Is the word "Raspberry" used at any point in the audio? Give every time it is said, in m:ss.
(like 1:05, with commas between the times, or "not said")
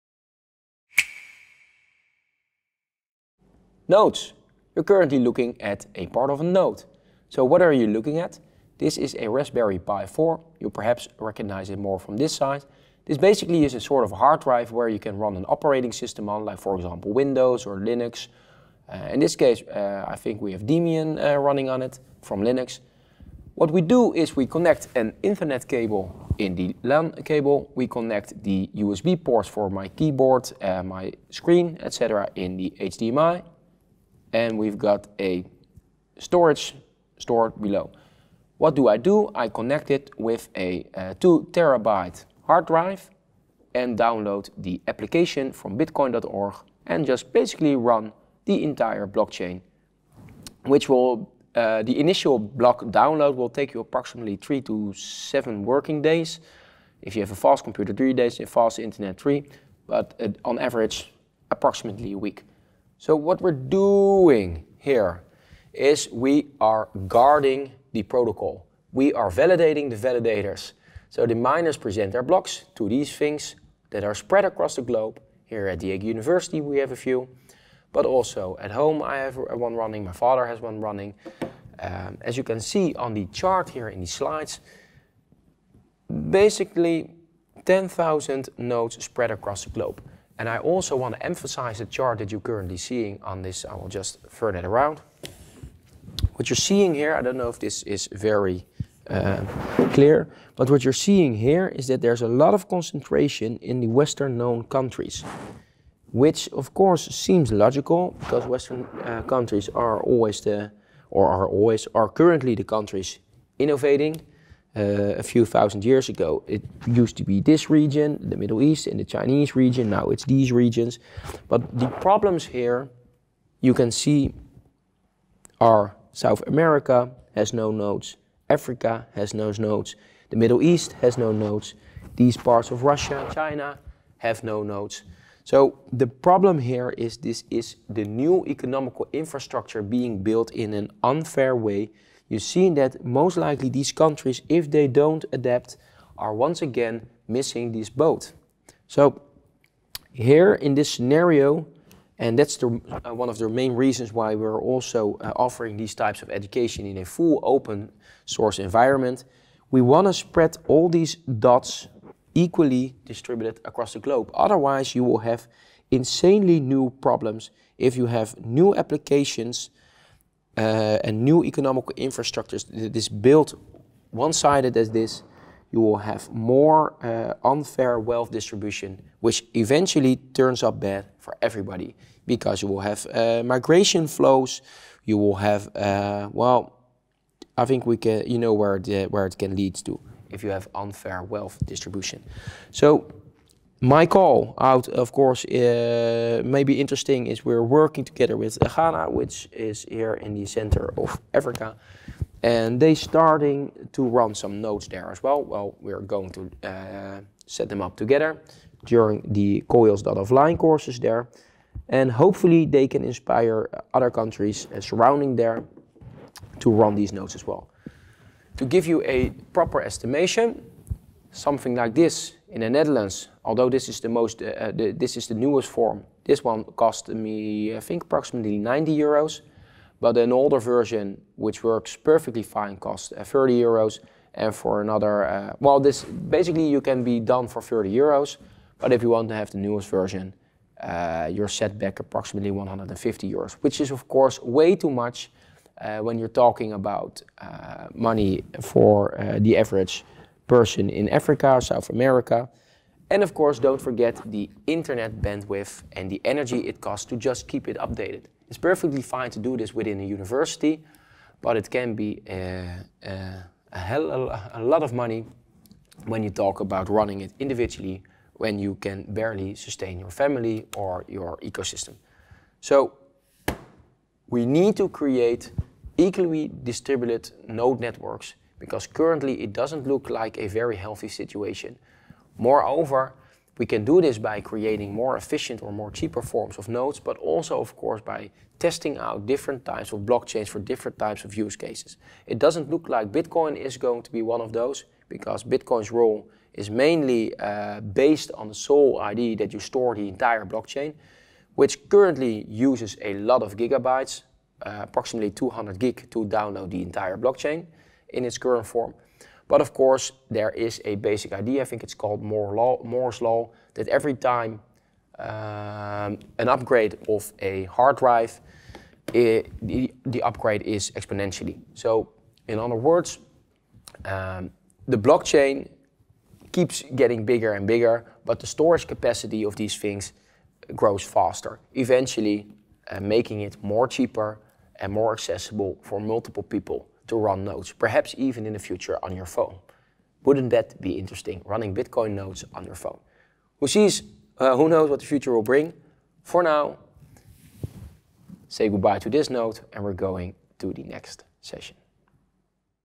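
0:09.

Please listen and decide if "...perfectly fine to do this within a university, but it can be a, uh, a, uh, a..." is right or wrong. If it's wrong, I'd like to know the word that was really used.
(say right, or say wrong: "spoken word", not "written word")
right.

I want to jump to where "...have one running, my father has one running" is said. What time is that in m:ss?
1:19.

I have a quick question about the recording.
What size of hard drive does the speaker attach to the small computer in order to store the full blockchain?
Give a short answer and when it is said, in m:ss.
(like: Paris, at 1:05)
2 terabytes, at 0:41.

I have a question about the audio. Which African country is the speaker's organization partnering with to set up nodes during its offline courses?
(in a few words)
Ghana.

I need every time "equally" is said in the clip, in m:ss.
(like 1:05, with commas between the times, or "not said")
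2:42, 4:36.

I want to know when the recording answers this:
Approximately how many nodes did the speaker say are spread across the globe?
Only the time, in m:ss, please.
1:27.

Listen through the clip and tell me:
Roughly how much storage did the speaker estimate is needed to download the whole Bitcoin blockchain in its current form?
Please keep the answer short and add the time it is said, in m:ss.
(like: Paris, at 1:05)
200 gigabytes, at 5:05.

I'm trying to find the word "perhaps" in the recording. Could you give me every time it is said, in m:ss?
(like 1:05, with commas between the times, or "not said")
0:10, 5:37.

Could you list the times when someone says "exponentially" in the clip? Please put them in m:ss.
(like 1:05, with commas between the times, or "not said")
5:20.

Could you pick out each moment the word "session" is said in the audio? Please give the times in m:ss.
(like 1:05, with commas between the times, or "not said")
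5:51.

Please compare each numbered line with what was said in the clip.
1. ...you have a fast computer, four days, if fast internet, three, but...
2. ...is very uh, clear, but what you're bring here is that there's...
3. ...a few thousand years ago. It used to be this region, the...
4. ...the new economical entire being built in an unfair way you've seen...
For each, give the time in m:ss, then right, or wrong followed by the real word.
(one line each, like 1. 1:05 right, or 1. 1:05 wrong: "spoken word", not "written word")
1. 0:57 wrong: "three", not "four"
2. 1:37 wrong: "seeing", not "bring"
3. 1:55 right
4. 2:17 wrong: "infrastructure", not "entire".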